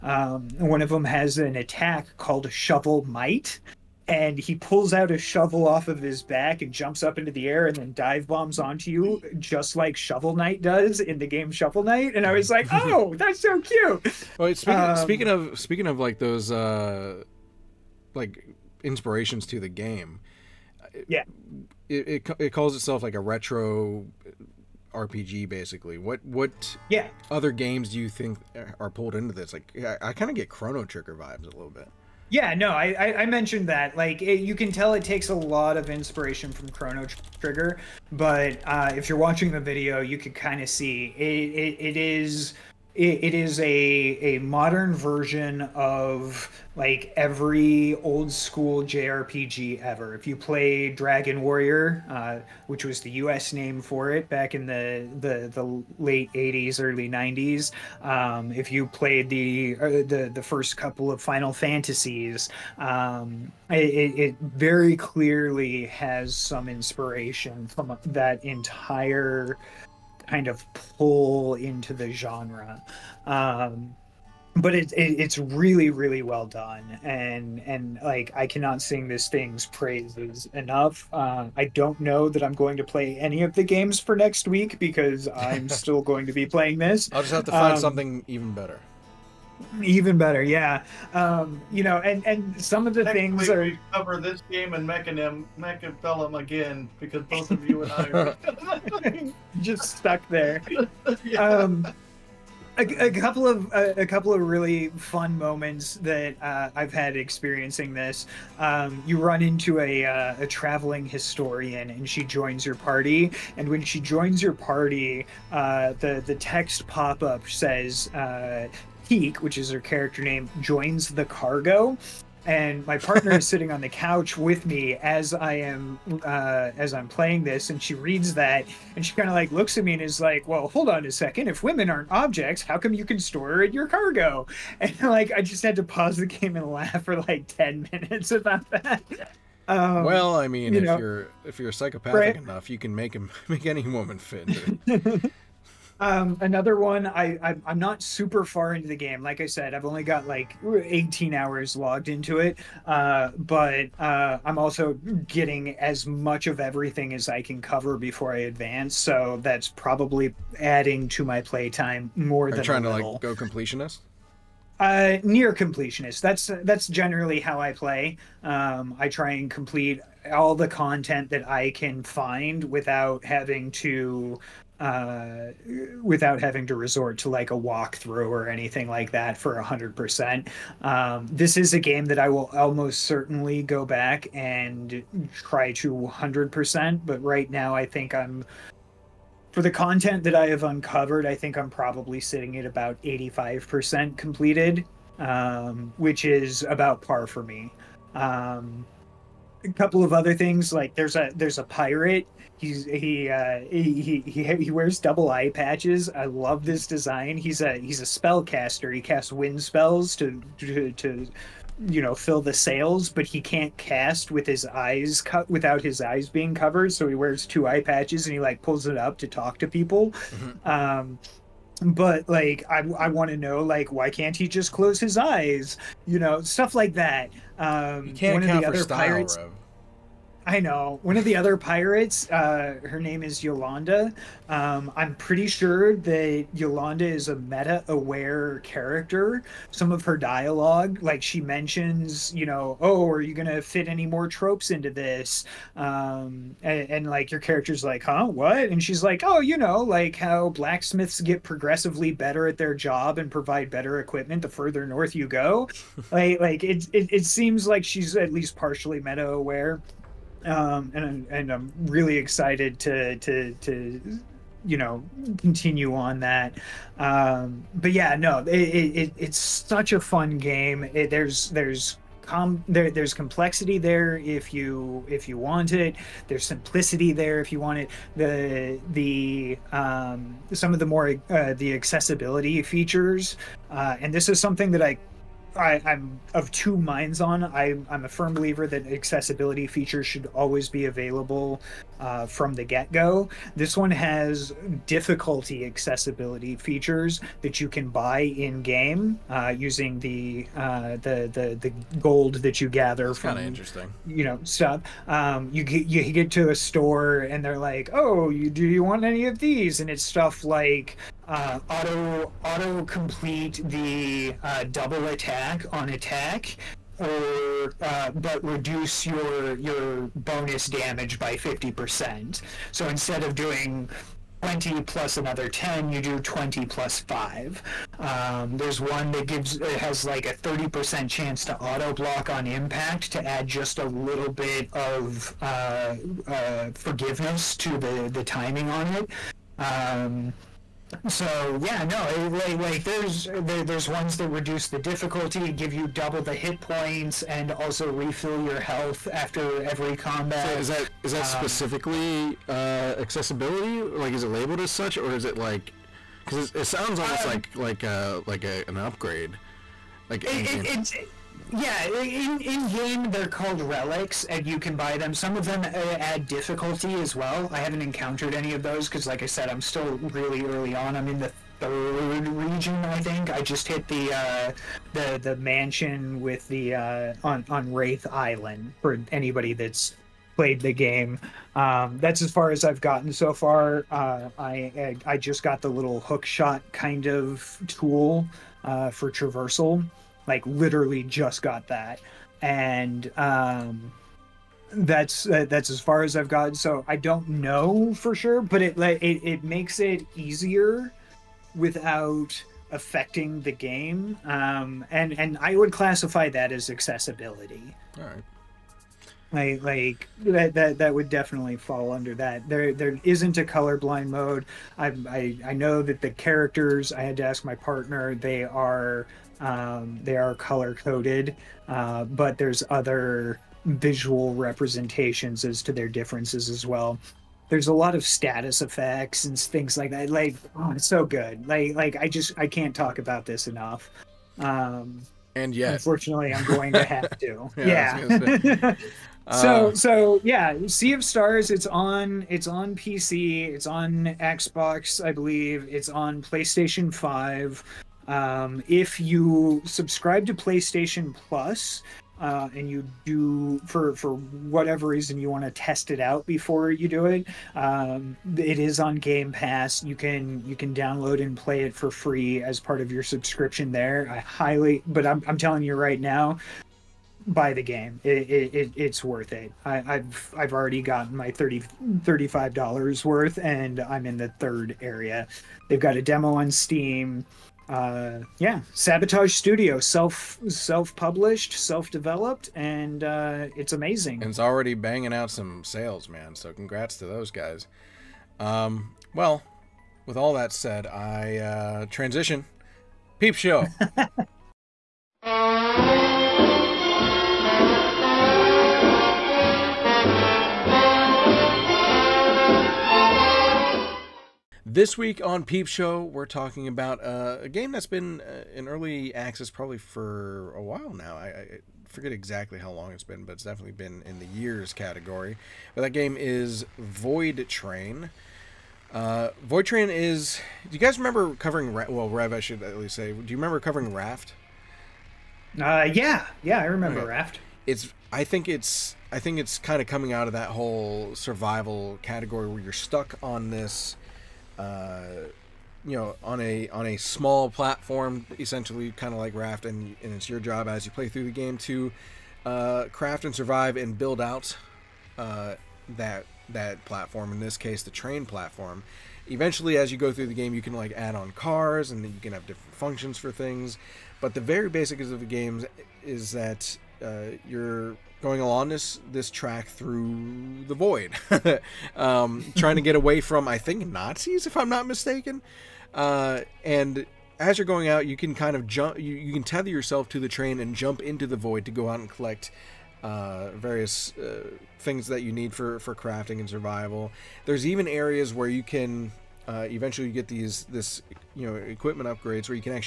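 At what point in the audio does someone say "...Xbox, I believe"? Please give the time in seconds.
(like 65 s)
444 s.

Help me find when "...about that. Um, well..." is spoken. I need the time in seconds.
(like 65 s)
138 s.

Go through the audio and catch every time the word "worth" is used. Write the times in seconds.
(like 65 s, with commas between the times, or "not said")
469 s, 473 s.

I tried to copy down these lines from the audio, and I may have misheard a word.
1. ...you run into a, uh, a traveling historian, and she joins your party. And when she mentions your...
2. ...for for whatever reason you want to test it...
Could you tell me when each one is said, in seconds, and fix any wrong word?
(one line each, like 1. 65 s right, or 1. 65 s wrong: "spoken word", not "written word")
1. 109 s wrong: "joins", not "mentions"
2. 453 s right.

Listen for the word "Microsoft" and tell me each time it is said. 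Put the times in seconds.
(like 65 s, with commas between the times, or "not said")
not said.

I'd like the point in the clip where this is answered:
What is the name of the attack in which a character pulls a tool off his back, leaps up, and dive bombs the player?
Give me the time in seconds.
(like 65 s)
2 s.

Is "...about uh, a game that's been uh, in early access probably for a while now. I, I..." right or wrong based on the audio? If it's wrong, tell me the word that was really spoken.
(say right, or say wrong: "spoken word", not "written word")
right.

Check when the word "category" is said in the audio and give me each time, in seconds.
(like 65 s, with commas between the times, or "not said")
514 s, 532 s.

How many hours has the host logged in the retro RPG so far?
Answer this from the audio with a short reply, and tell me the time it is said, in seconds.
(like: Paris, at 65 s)
18, at 150 s.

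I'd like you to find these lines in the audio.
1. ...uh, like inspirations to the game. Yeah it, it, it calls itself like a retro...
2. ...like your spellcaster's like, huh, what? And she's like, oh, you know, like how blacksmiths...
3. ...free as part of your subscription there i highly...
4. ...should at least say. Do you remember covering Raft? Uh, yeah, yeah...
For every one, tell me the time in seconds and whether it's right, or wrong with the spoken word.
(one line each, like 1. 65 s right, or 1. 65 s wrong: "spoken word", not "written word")
1. 16 s right
2. 247 s wrong: "character", not "spellcaster"
3. 461 s right
4. 522 s right.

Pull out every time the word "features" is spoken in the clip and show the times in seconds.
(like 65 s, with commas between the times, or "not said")
282 s, 289 s, 296 s.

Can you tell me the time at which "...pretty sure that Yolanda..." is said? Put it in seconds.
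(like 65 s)
235 s.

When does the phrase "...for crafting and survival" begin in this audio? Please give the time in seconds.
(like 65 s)
575 s.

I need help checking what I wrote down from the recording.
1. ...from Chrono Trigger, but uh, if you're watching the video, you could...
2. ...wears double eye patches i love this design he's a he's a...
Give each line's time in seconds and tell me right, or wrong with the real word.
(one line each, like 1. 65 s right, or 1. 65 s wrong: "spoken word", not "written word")
1. 36 s right
2. 204 s right.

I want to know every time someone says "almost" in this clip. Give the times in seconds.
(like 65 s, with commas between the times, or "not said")
182 s, 356 s.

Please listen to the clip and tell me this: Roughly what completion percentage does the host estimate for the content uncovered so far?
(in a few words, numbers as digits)
85%.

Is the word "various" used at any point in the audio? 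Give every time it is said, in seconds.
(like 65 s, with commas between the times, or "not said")
573 s.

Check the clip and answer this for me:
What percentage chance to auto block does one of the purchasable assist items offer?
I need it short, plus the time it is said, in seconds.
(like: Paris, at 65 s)
30%, at 330 s.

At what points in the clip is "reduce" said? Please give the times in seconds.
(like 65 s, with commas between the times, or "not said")
318 s, 344 s.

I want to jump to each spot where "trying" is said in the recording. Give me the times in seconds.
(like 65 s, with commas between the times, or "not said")
162 s, 562 s.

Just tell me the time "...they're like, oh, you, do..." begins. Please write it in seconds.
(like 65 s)
307 s.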